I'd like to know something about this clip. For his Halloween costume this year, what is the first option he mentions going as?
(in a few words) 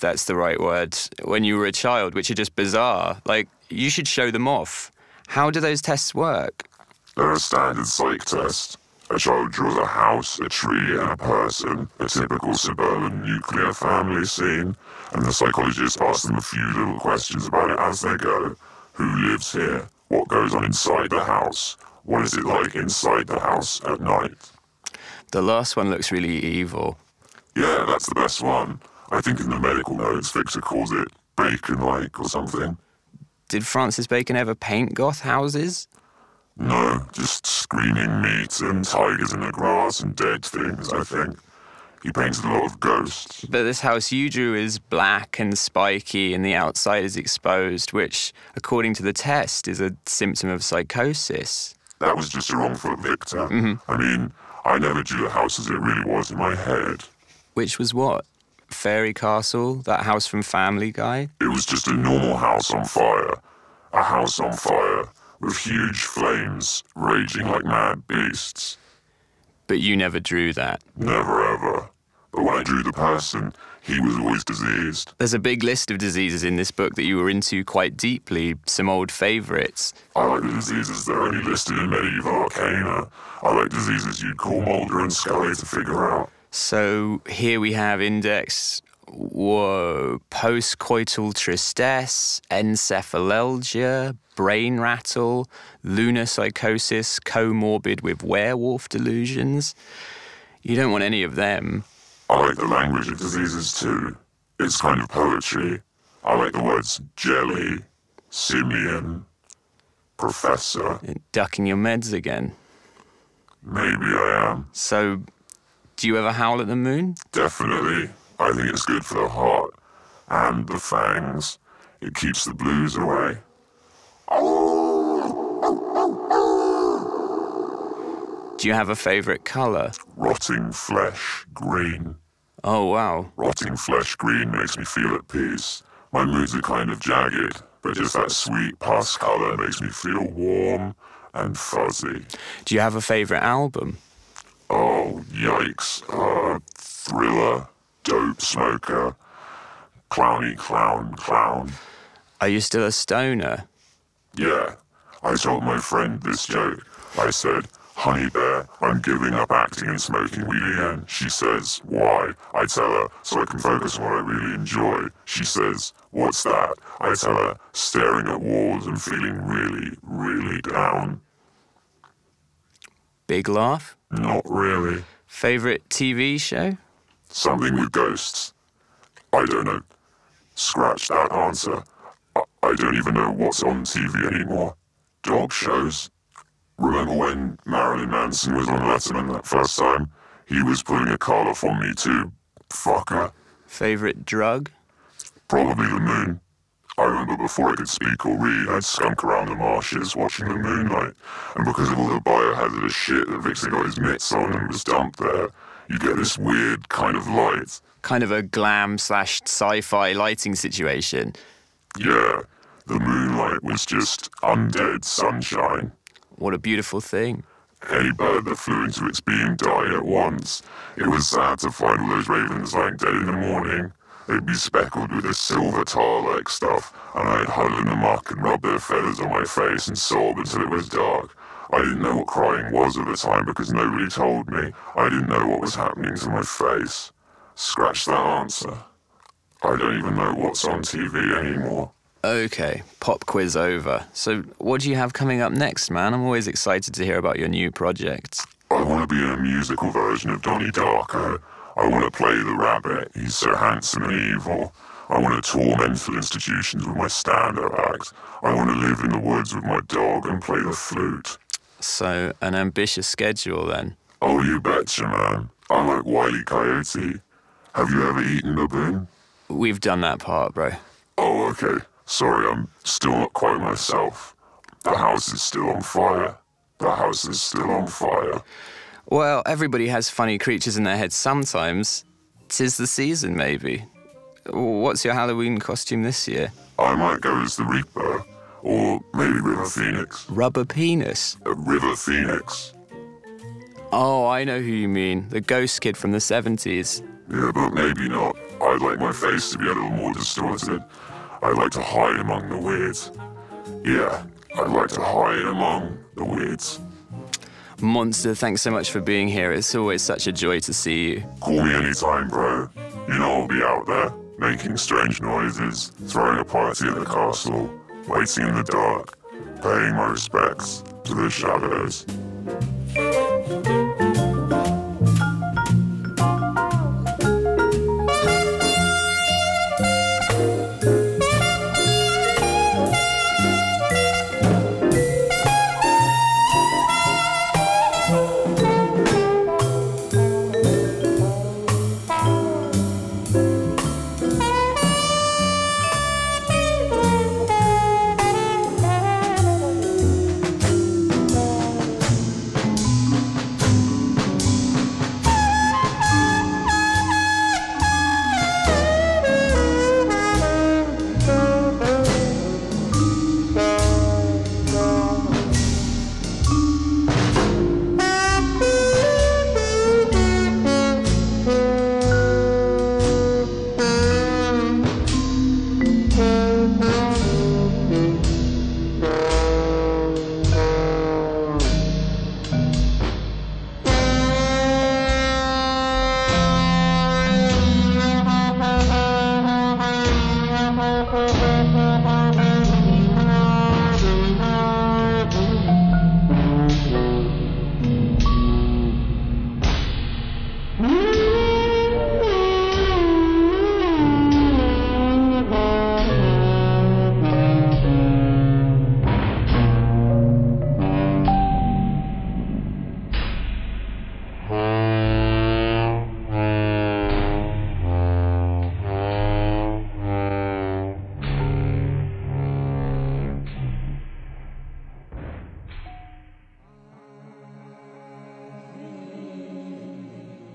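the Reaper.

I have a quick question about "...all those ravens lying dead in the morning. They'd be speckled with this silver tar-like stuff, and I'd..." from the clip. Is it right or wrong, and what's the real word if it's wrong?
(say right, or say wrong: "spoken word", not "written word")
right.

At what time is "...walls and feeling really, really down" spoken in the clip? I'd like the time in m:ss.
2:48.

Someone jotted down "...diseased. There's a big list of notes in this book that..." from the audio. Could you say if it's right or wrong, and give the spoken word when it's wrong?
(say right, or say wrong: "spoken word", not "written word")
wrong: "diseases", not "notes".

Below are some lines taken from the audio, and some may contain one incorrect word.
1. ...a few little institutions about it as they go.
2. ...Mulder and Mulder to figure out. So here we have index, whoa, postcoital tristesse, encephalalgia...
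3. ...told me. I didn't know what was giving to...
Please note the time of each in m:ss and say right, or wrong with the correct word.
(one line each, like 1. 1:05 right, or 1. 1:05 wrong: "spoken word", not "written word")
1. 0:16 wrong: "questions", not "institutions"
2. 1:24 wrong: "Scully", not "Mulder"
3. 3:54 wrong: "happening", not "giving".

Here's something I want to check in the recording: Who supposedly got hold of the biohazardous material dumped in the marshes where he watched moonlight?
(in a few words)
Vixen.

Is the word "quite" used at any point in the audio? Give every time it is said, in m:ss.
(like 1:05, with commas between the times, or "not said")
1:17, 4:33.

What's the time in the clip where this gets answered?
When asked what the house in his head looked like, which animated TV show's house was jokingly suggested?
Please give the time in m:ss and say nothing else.
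1:00.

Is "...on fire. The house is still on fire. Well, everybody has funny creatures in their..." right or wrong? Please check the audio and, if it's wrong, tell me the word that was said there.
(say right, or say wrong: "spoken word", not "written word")
right.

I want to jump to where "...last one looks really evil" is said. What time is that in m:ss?
0:25.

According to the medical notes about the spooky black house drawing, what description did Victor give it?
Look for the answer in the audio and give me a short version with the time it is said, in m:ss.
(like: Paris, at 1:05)
bacon like, at 0:31.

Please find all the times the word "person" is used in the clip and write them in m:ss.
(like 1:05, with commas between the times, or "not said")
0:11, 1:12.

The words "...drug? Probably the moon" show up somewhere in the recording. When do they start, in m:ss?
3:14.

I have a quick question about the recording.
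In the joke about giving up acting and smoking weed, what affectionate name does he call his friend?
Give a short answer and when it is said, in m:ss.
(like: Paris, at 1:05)
Honey Bear, at 2:37.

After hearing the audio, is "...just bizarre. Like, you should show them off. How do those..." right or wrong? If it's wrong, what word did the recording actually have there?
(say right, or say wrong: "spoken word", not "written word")
right.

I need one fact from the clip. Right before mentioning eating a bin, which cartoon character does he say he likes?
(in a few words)
Wiley Coyote.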